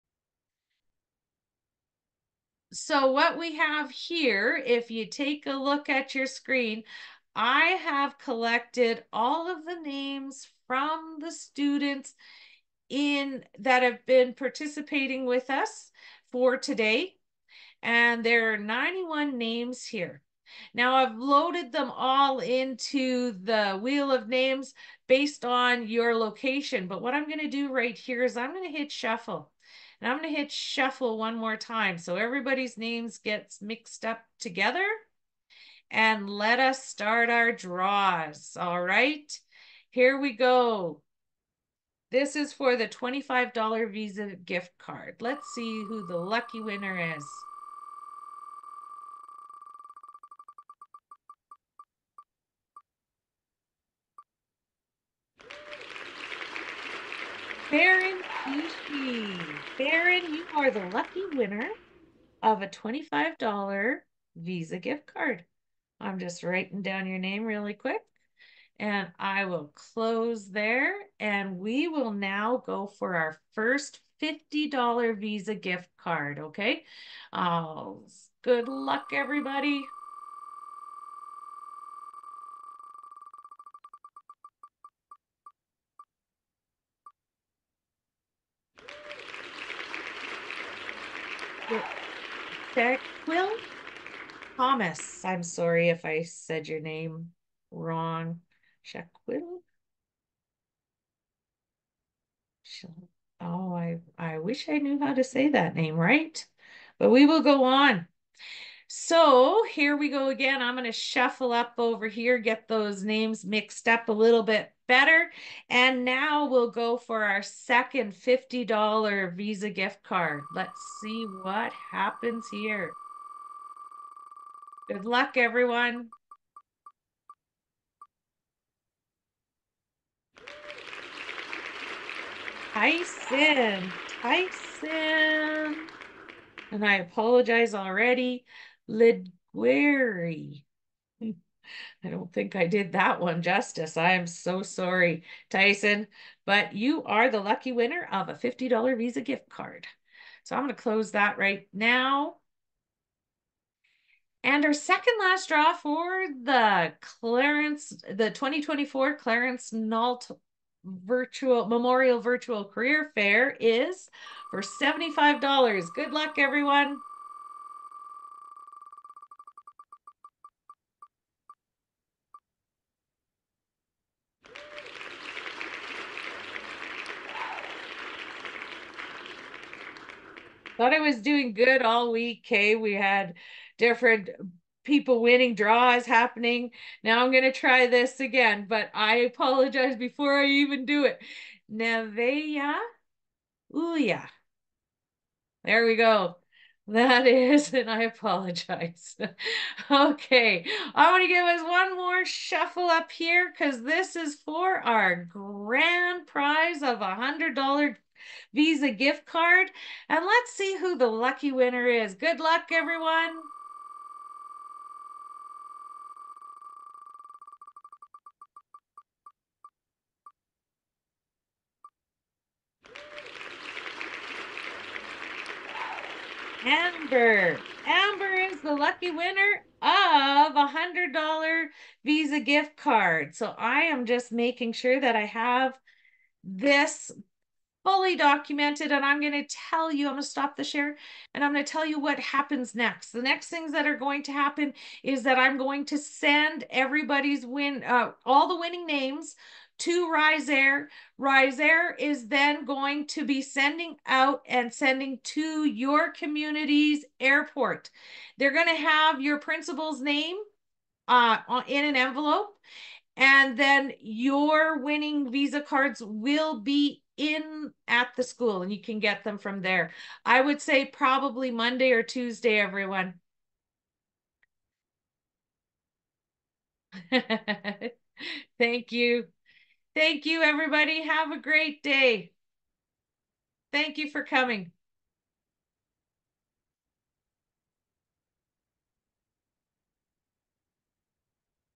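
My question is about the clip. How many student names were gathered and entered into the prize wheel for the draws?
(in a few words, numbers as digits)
91.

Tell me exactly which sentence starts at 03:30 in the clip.
And let's see who the lucky winner is.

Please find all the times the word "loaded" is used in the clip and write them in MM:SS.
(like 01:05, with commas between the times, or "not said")
00:21.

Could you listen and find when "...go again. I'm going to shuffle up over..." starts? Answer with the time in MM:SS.
01:50.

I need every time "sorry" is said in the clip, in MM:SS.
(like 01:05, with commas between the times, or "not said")
01:35, 02:24.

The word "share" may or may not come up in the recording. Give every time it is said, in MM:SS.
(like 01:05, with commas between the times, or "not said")
04:00.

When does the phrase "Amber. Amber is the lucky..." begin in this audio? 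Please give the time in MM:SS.
03:46.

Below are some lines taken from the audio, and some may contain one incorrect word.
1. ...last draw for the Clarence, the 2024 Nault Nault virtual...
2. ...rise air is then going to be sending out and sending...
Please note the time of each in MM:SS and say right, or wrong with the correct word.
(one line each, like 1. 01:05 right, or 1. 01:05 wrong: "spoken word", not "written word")
1. 02:35 wrong: "Clarence", not "Nault"
2. 04:11 right.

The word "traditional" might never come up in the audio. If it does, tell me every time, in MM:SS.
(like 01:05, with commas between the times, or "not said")
not said.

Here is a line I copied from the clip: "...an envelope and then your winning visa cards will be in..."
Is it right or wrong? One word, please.
right.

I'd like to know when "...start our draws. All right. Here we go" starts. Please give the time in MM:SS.
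00:36.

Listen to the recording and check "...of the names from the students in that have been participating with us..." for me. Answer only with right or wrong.
right.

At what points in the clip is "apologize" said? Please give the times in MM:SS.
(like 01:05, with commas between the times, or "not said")
02:16, 03:09, 03:18.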